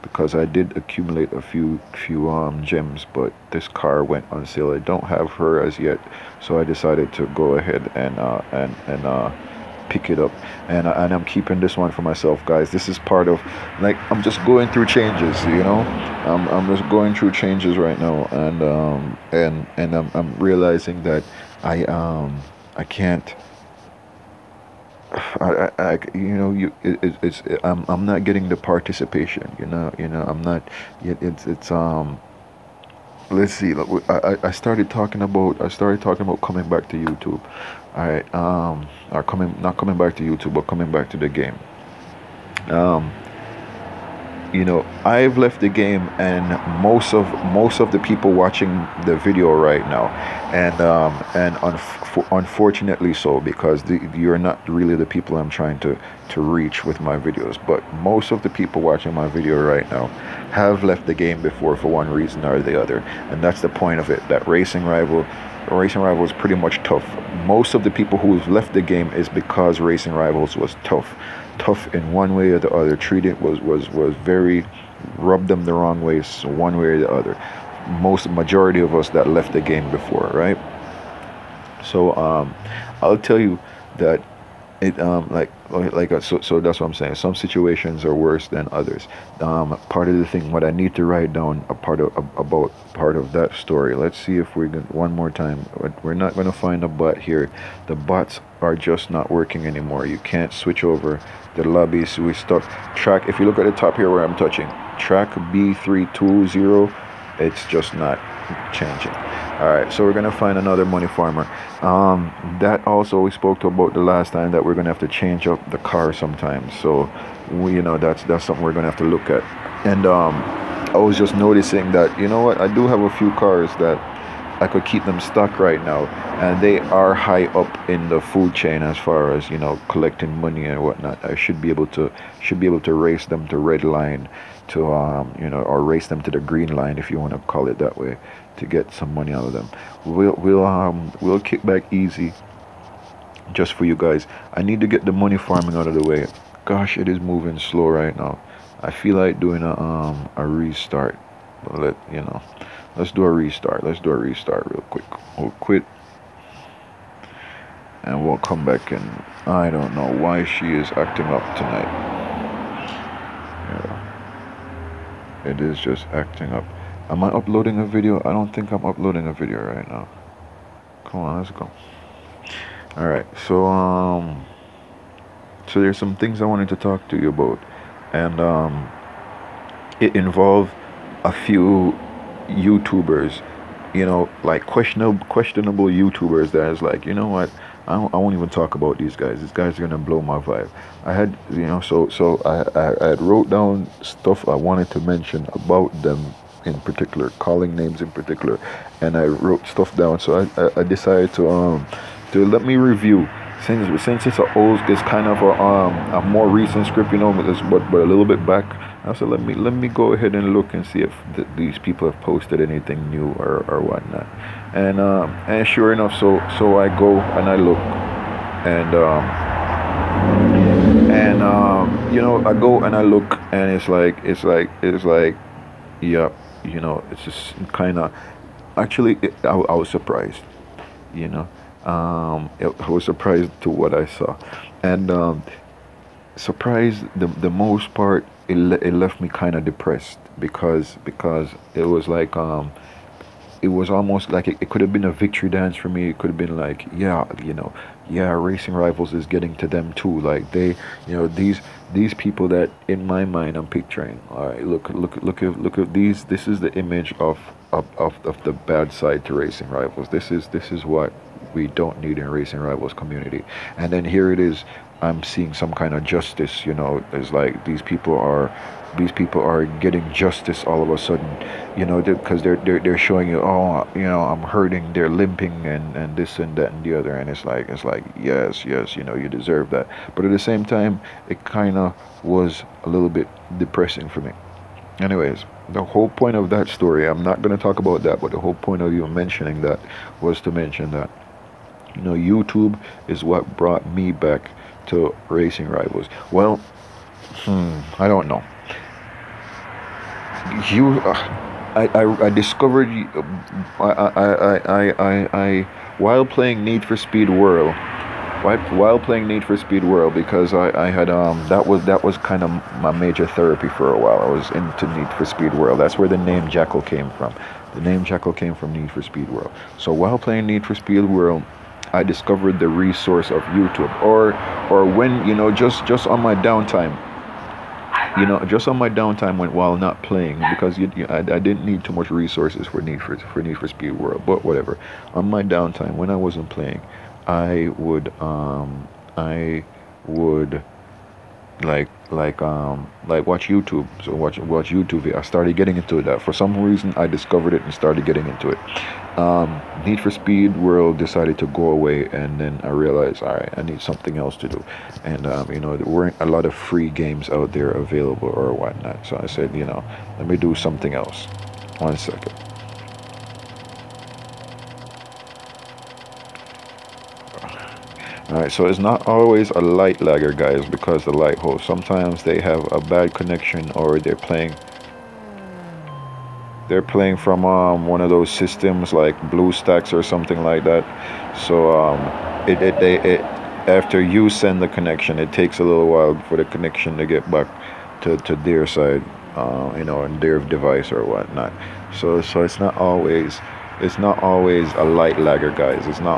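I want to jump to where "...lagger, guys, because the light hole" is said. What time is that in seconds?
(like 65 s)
370 s.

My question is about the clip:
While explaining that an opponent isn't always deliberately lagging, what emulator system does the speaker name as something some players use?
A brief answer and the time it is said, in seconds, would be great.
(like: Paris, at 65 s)
BlueStacks, at 379 s.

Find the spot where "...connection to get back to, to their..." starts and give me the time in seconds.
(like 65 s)
386 s.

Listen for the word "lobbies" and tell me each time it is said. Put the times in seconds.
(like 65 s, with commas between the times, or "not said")
101 s.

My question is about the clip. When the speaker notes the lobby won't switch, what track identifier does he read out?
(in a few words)
B320.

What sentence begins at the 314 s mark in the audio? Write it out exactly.
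I was into Need for Speed World.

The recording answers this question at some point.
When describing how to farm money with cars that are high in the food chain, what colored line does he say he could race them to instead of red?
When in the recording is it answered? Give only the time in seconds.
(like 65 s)
136 s.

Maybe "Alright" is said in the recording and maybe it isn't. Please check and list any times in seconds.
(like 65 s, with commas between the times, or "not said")
172 s, 368 s.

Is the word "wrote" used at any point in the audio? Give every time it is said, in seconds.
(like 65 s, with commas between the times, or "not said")
193 s, 199 s.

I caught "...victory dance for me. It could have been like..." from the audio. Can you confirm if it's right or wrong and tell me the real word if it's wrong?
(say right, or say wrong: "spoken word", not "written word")
right.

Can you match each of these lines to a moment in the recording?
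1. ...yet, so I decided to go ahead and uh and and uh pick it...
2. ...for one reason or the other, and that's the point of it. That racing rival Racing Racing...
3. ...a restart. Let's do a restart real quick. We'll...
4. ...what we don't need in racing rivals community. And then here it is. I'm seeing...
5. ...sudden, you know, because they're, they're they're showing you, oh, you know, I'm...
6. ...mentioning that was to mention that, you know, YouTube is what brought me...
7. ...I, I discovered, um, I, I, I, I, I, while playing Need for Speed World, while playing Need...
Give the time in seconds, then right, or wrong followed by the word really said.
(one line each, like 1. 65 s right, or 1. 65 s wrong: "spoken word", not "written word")
1. 5 s right
2. 61 s wrong: "Rivals", not "Racing"
3. 153 s right
4. 260 s right
5. 270 s right
6. 289 s right
7. 301 s right.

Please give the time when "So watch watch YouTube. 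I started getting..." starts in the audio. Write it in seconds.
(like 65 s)
344 s.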